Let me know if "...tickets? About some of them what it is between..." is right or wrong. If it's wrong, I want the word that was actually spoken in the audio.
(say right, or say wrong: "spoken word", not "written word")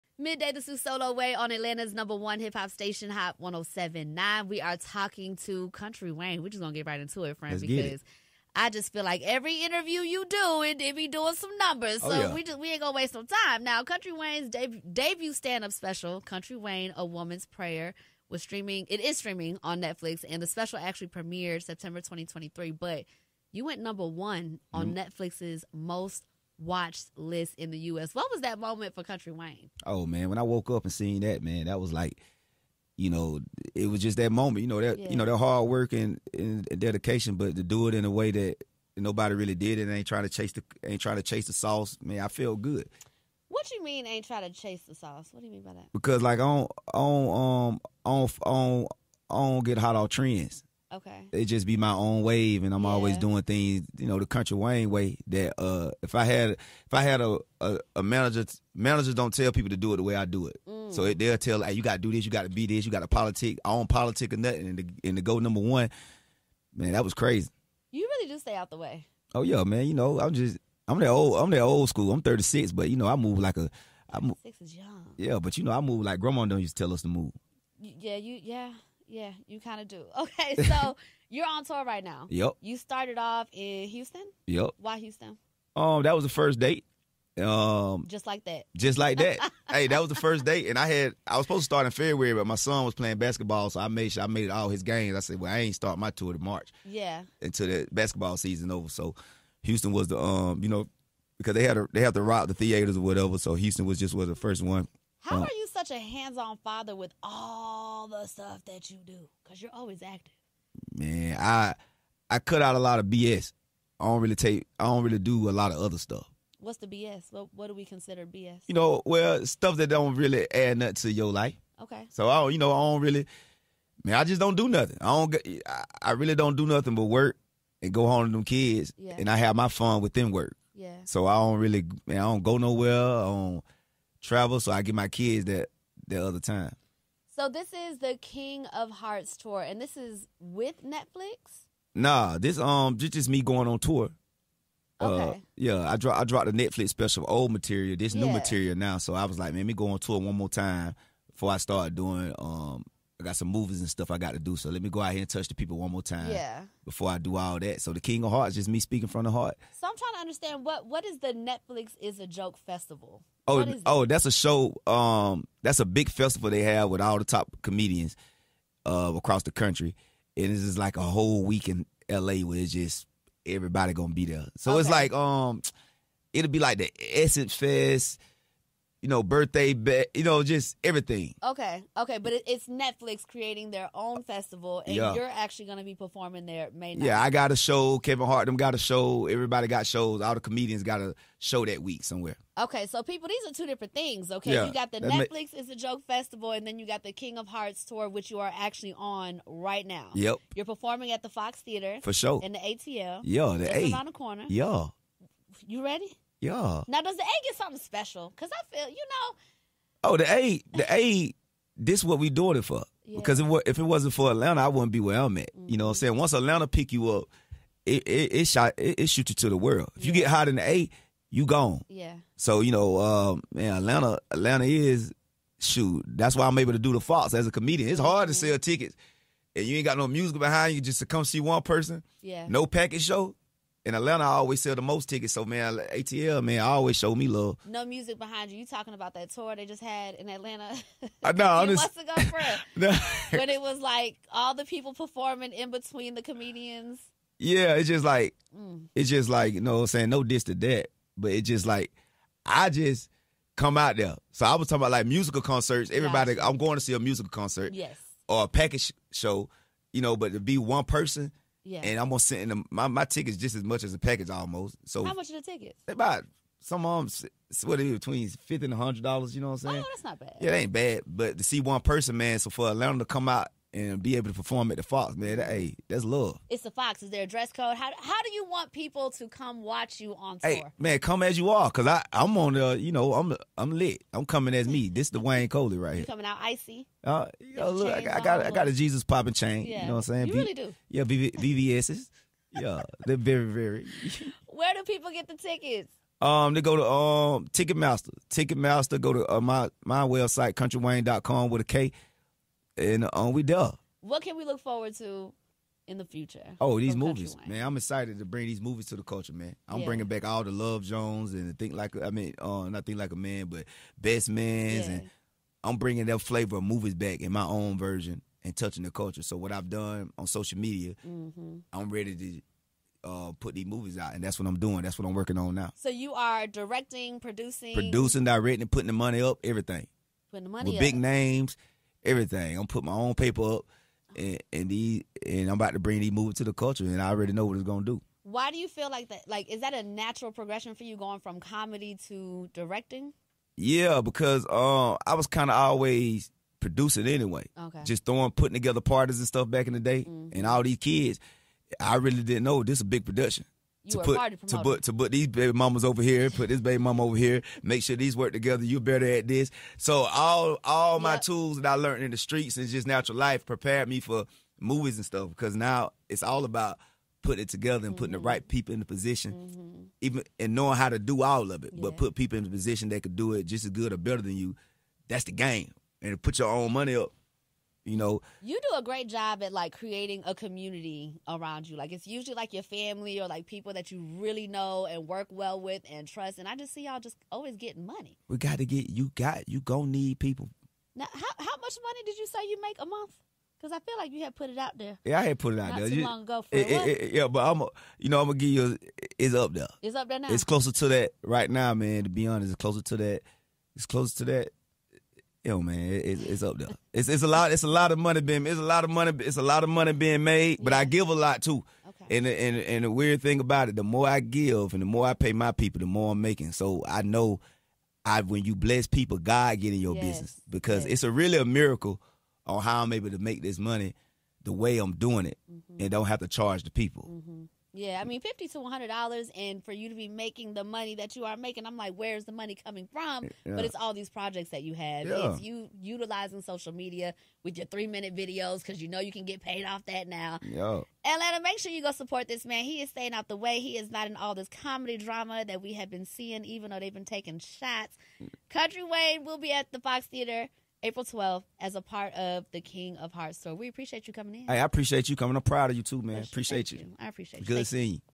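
right.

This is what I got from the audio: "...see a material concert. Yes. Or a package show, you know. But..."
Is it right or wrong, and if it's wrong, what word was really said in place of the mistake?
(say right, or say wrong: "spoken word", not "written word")
wrong: "musical", not "material".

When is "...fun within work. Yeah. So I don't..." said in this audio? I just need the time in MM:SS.
02:09.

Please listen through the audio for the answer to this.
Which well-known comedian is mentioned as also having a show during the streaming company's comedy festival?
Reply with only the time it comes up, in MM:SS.
03:07.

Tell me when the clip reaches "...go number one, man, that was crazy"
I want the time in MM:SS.
01:05.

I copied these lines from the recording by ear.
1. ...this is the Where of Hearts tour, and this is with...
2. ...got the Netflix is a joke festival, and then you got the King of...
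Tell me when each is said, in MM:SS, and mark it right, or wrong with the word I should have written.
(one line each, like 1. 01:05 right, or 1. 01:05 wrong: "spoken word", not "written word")
1. 02:17 wrong: "King", not "Where"
2. 03:14 right.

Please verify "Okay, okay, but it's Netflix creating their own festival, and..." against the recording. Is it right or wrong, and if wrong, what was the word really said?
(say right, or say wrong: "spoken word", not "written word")
right.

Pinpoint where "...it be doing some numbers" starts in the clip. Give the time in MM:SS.
00:10.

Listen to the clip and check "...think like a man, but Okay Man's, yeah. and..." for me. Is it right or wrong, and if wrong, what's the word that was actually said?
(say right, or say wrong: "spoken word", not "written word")
wrong: "Best", not "Okay".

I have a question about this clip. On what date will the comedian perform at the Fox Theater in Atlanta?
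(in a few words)
April 12.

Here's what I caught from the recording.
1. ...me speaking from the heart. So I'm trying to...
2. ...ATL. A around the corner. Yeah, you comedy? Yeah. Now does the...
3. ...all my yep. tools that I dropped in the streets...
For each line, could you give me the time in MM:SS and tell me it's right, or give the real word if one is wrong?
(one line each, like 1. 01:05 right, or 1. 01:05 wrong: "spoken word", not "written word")
1. 02:38 right
2. 03:23 wrong: "ready", not "comedy"
3. 06:00 wrong: "learned", not "dropped".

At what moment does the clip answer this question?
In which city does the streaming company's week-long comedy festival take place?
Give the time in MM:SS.
02:52.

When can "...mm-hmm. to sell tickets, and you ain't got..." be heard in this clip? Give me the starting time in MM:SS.
03:48.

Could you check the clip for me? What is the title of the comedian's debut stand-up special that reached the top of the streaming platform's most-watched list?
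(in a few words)
A Woman's Prayer.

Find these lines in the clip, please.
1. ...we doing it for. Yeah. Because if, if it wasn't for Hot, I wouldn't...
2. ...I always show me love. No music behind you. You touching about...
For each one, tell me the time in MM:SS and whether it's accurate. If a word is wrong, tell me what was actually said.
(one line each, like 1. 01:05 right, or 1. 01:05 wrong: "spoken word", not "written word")
1. 03:32 wrong: "Atlanta", not "Hot"
2. 03:56 wrong: "talking", not "touching".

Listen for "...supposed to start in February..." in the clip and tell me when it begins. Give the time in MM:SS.
01:31.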